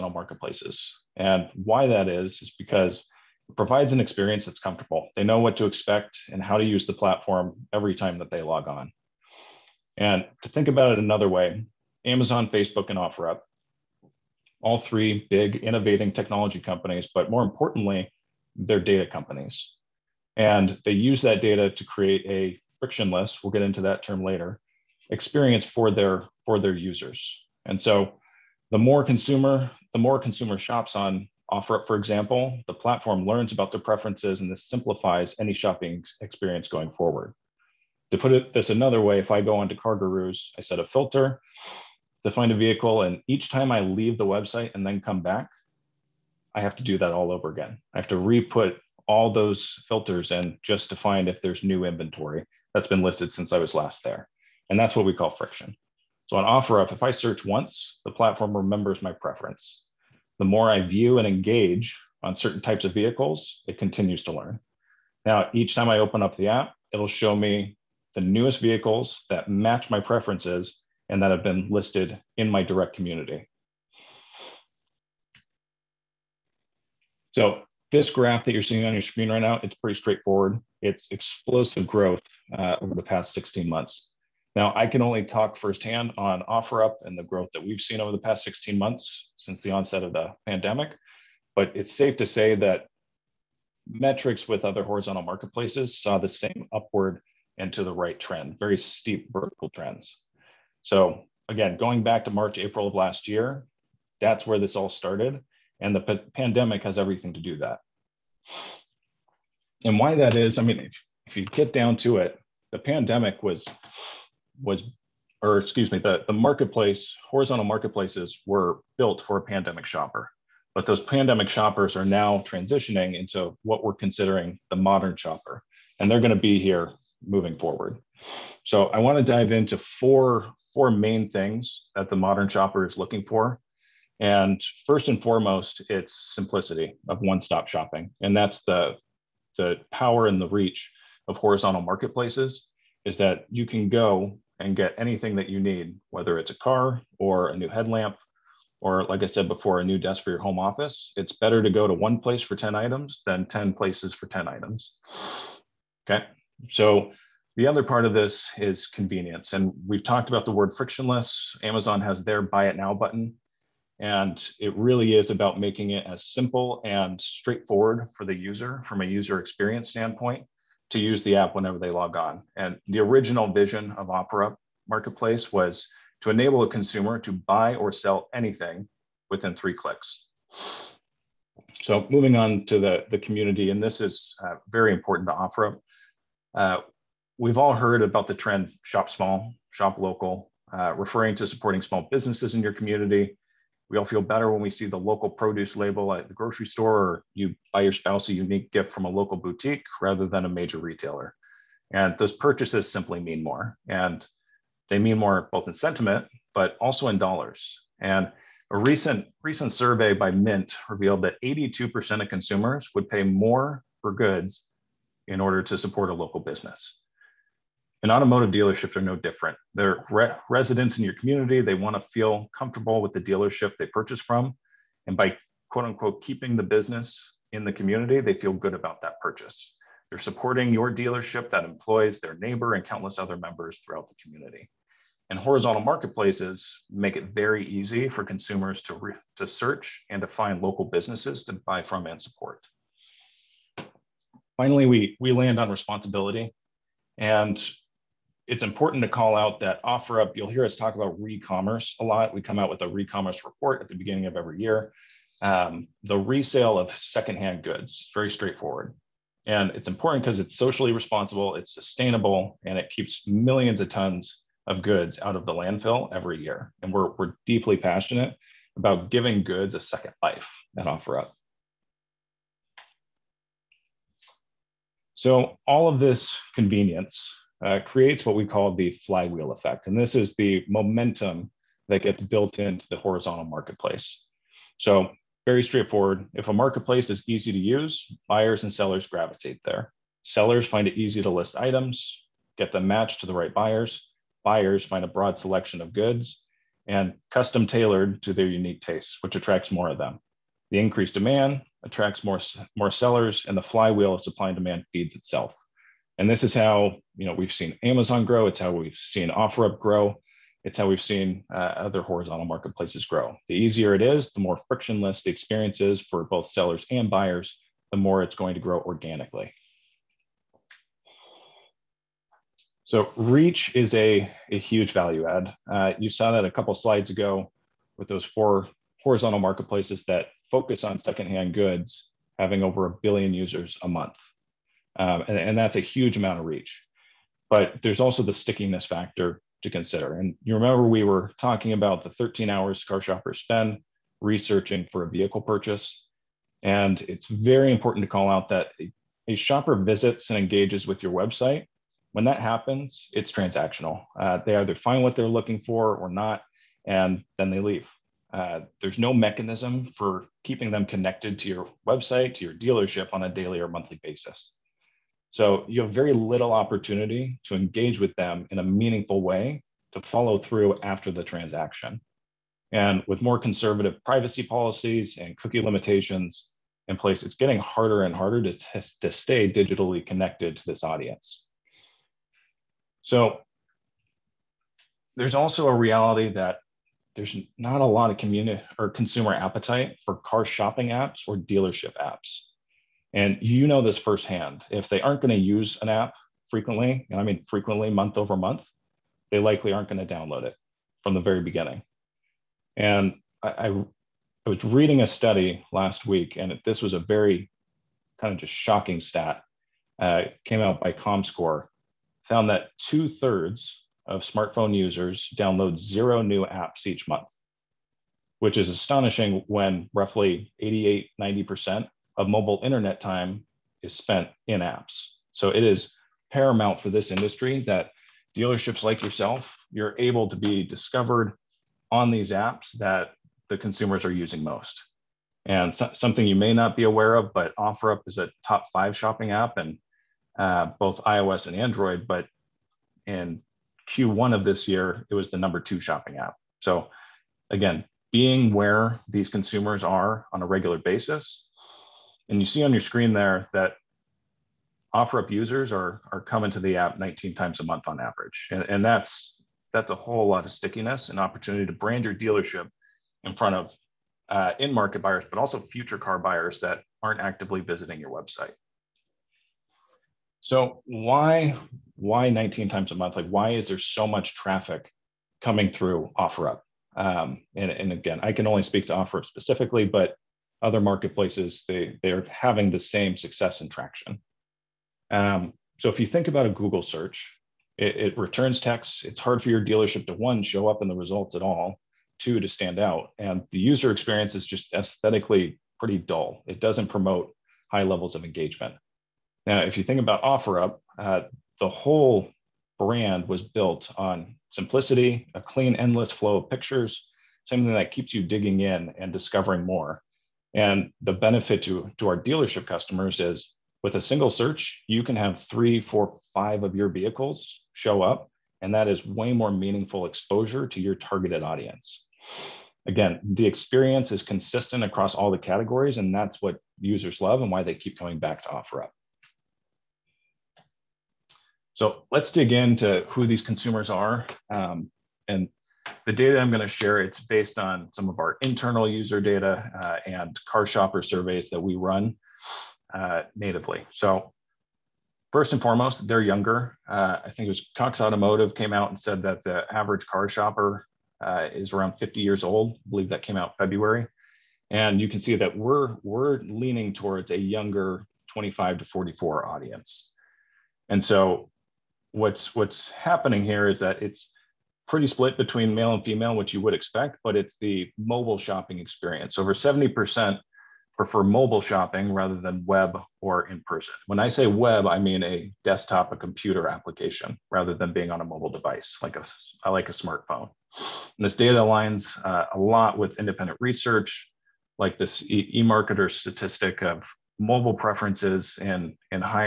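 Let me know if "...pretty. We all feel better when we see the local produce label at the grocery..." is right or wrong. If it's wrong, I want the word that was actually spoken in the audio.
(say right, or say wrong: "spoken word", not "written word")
wrong: "community", not "pretty".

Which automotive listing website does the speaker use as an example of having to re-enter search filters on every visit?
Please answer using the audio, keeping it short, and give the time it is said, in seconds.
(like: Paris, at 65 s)
CarGurus, at 39 s.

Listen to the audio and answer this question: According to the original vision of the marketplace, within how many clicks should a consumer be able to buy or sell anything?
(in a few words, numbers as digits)
3.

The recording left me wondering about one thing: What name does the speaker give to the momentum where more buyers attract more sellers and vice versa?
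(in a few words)
flywheel effect.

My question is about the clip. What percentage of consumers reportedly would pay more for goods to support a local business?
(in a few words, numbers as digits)
82%.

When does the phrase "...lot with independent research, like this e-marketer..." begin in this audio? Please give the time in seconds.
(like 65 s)
582 s.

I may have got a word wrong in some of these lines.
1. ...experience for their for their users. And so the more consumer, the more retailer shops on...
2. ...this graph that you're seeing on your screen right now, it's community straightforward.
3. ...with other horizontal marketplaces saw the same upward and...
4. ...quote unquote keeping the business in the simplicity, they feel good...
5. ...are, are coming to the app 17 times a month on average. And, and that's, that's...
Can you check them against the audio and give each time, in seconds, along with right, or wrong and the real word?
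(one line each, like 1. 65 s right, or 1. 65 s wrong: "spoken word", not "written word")
1. 25 s wrong: "consumer", not "retailer"
2. 77 s wrong: "pretty", not "community"
3. 94 s right
4. 225 s wrong: "community", not "simplicity"
5. 455 s wrong: "19", not "17".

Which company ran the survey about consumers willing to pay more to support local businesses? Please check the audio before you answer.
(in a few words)
Mint.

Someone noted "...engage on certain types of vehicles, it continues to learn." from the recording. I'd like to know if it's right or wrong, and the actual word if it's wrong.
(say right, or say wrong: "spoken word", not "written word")
right.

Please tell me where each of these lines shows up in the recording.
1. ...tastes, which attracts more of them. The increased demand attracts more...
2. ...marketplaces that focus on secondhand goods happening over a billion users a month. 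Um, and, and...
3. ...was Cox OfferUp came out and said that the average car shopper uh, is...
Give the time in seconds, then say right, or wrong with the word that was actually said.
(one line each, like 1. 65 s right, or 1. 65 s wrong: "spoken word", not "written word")
1. 298 s right
2. 329 s wrong: "having", not "happening"
3. 547 s wrong: "Automotive", not "OfferUp".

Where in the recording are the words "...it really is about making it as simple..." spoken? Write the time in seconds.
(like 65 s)
164 s.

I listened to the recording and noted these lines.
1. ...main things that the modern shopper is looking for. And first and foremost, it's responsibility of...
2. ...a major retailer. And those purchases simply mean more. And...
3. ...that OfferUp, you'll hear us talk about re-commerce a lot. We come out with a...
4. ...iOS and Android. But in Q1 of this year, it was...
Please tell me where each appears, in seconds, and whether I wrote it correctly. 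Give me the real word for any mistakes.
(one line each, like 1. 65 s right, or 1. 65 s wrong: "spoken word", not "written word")
1. 130 s wrong: "simplicity", not "responsibility"
2. 200 s right
3. 249 s right
4. 441 s right.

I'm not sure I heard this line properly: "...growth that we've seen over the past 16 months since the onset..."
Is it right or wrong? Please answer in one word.
right.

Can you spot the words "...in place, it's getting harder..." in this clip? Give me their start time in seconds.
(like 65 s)
376 s.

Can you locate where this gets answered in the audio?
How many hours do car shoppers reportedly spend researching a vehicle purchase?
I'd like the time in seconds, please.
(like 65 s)
342 s.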